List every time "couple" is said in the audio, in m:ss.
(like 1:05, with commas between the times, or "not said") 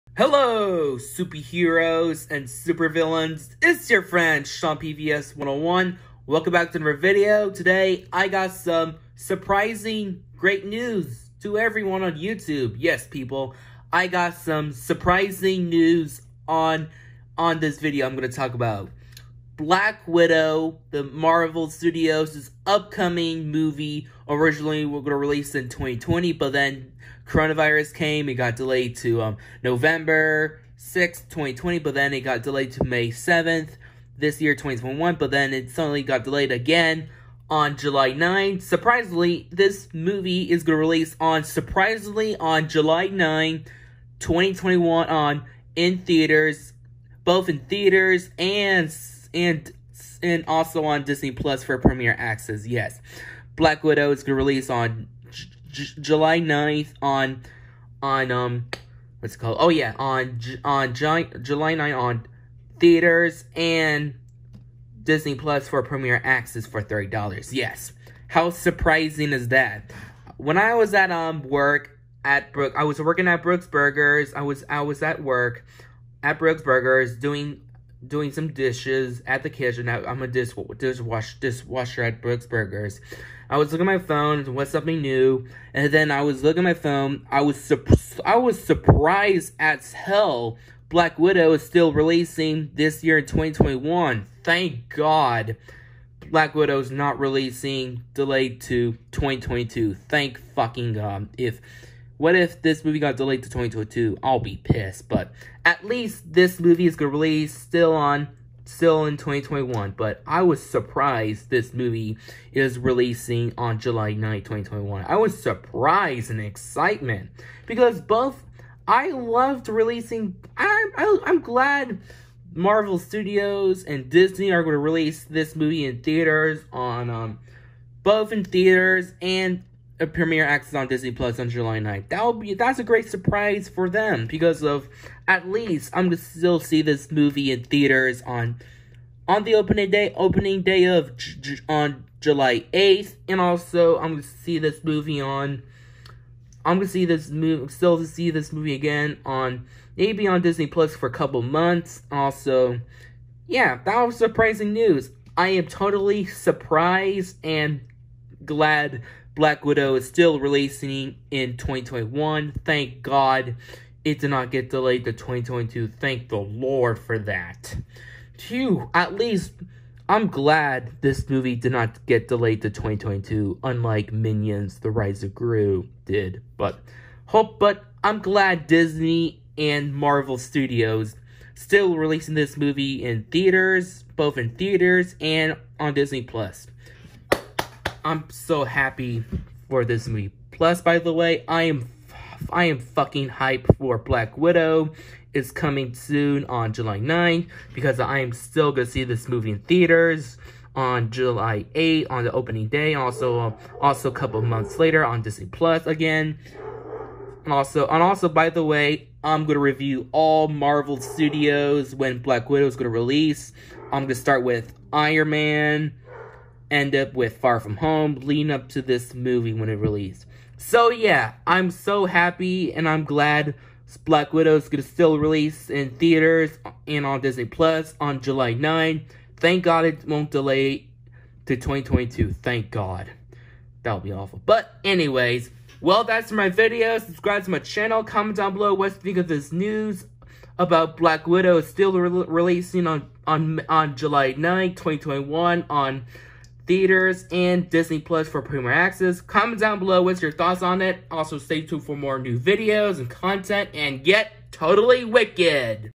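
2:31, 3:24.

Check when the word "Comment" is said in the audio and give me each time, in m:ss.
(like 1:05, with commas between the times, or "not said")
3:58, 4:09.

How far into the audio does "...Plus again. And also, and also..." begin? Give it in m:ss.
3:25.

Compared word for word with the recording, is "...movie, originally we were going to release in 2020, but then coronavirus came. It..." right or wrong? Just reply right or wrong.
right.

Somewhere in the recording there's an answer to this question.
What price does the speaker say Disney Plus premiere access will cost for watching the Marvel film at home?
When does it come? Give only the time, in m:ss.
1:06.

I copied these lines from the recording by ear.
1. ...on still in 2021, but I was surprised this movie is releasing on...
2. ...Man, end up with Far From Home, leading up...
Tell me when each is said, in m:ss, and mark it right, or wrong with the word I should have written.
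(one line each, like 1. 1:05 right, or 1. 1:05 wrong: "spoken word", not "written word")
1. 1:47 right
2. 3:35 right.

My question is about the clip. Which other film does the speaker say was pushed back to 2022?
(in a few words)
Minions The Rise of Gru.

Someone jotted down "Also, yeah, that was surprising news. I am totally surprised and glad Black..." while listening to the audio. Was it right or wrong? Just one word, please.
right.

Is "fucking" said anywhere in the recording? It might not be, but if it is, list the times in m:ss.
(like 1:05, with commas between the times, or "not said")
1:40, 3:12.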